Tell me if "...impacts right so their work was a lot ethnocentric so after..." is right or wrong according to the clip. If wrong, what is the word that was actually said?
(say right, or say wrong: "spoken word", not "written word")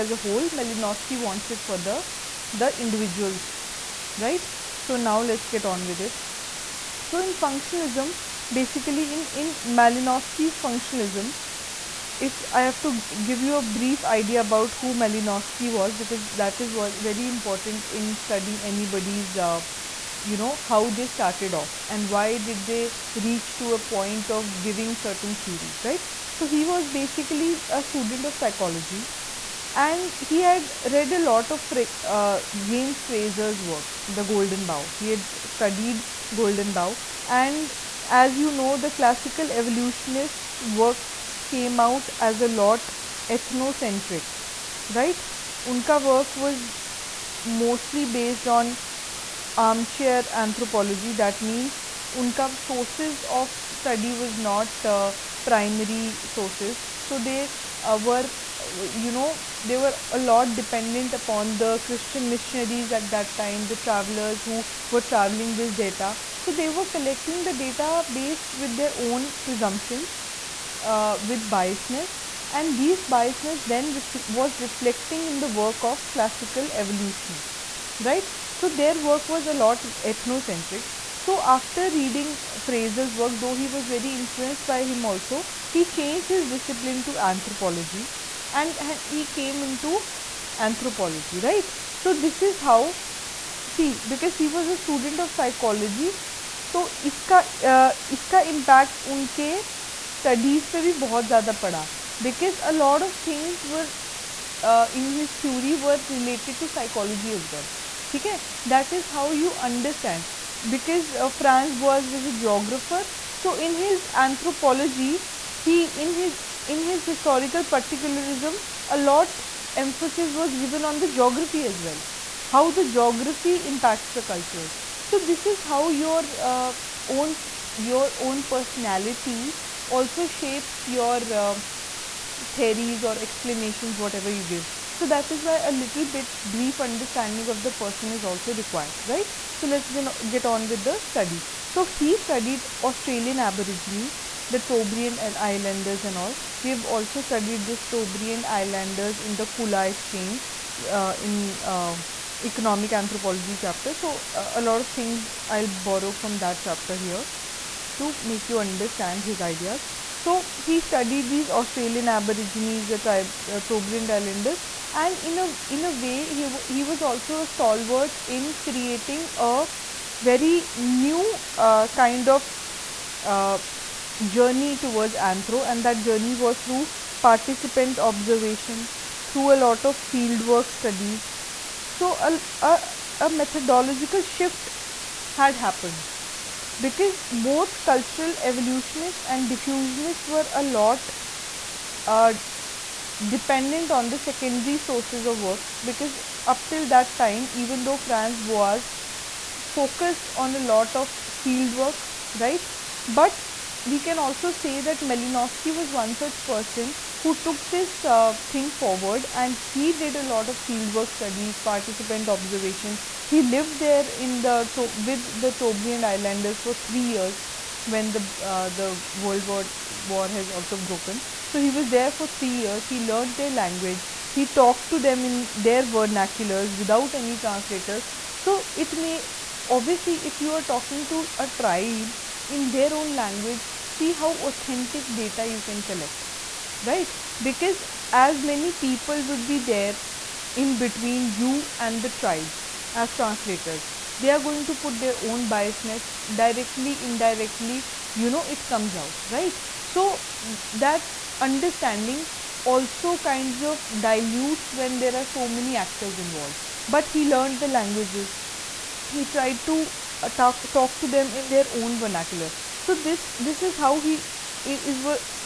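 wrong: "evolutionists", not "impacts".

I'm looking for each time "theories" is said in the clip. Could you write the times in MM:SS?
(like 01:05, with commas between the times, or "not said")
00:25, 02:12.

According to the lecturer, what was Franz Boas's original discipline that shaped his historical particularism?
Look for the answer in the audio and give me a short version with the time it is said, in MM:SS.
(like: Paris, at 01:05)
Geographer, at 01:52.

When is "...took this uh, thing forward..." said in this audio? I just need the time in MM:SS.
03:27.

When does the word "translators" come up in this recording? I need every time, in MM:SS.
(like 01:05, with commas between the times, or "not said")
03:47, 04:03.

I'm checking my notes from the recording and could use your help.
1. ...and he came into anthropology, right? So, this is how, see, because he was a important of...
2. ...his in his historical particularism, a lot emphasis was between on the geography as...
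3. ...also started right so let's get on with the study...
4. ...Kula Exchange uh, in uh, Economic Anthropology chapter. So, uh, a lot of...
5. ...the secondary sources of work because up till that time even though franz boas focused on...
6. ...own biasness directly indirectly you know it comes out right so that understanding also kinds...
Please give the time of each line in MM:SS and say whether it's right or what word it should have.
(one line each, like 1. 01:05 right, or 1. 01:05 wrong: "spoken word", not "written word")
1. 01:28 wrong: "student", not "important"
2. 01:56 wrong: "given", not "between"
3. 02:18 wrong: "required", not "started"
4. 02:29 right
5. 03:14 right
6. 04:05 right.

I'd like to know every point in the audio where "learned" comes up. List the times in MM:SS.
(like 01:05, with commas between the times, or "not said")
03:43, 04:17.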